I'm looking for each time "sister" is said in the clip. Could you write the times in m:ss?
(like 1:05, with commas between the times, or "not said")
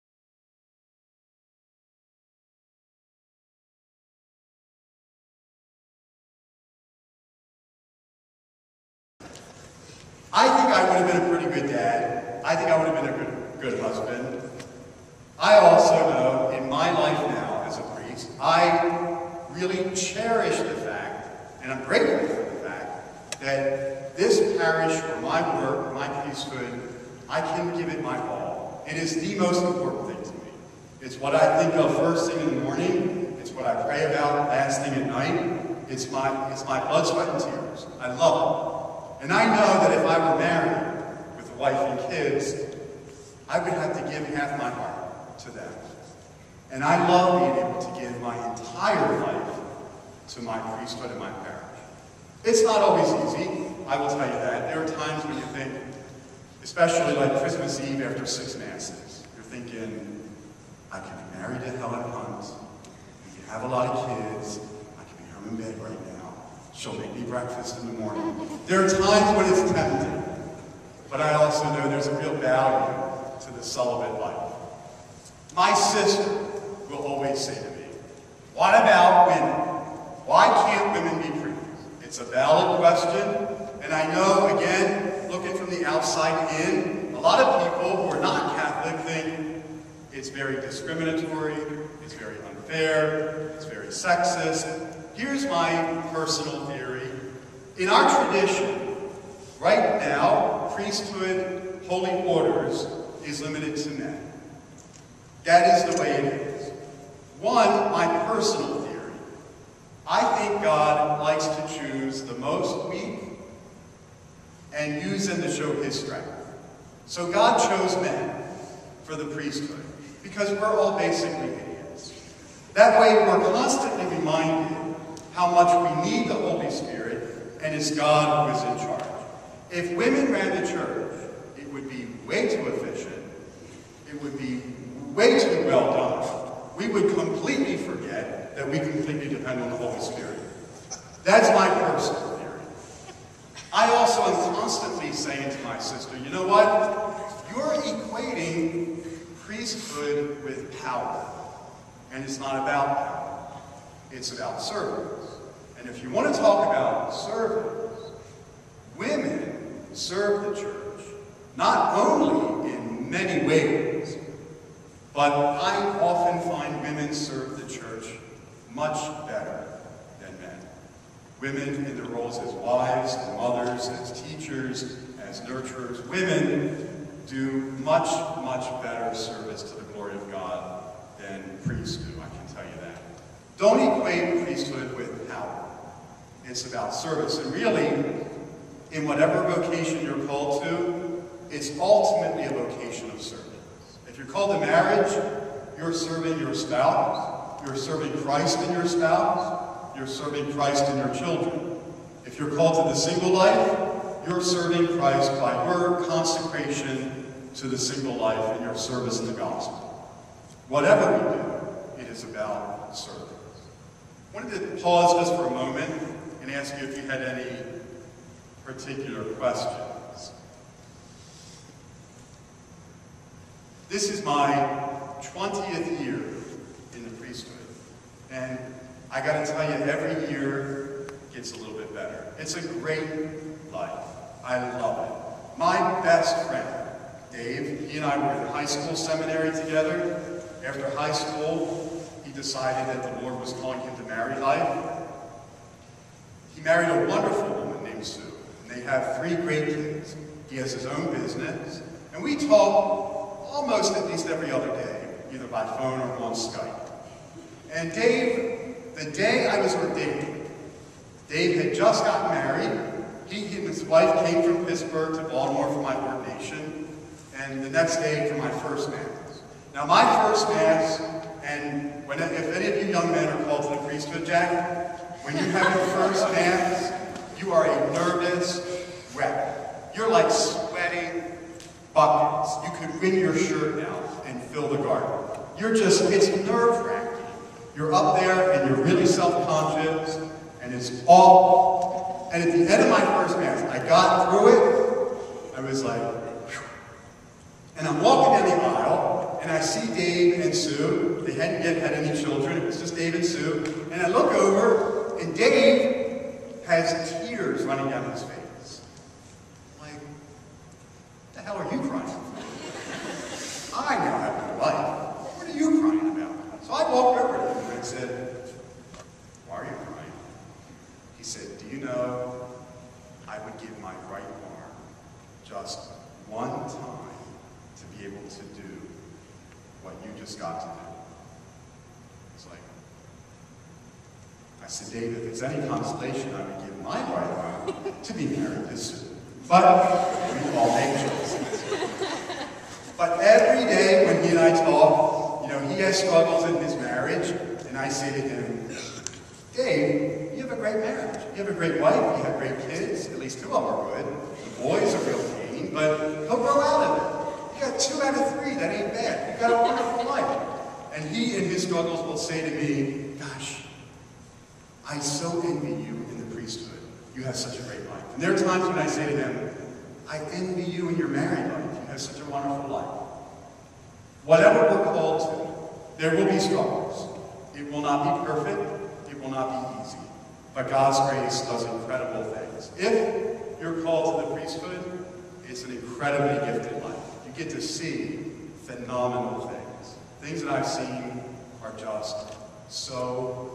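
1:15, 2:25.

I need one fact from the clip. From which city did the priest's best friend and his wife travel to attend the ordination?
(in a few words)
Pittsburgh.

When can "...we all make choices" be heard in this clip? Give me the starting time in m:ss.
5:39.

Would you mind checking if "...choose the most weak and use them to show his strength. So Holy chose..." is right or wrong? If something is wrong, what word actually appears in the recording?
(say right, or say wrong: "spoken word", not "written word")
wrong: "God", not "Holy".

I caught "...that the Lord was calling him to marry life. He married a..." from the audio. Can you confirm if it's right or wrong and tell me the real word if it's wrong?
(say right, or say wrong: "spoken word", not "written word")
right.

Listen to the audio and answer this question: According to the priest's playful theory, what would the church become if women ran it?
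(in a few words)
Way too efficient.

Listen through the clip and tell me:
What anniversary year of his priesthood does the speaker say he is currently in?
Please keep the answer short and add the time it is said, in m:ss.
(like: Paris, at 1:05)
20th, at 3:45.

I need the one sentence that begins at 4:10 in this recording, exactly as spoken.
He has his own business, and we talk almost at least every other day, either by phone or on Skype.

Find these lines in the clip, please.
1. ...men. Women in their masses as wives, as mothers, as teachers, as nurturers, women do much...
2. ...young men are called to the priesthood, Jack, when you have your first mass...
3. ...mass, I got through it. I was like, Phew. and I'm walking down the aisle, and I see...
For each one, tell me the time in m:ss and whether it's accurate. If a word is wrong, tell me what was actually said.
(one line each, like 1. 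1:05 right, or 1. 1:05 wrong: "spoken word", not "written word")
1. 2:50 wrong: "roles", not "masses"
2. 4:32 right
3. 4:53 right.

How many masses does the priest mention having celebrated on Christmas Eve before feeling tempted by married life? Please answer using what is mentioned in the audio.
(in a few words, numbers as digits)
6.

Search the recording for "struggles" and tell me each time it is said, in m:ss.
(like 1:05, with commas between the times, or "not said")
5:45, 6:01, 6:16.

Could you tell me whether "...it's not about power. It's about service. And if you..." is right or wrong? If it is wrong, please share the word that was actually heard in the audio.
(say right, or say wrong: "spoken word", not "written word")
right.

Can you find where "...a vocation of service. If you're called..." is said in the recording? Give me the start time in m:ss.
3:12.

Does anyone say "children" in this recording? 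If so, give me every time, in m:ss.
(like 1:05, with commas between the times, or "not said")
3:21, 5:02.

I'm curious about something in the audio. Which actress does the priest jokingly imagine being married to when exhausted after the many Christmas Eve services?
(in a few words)
Helen Hunt.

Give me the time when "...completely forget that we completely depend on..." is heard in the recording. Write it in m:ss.
2:17.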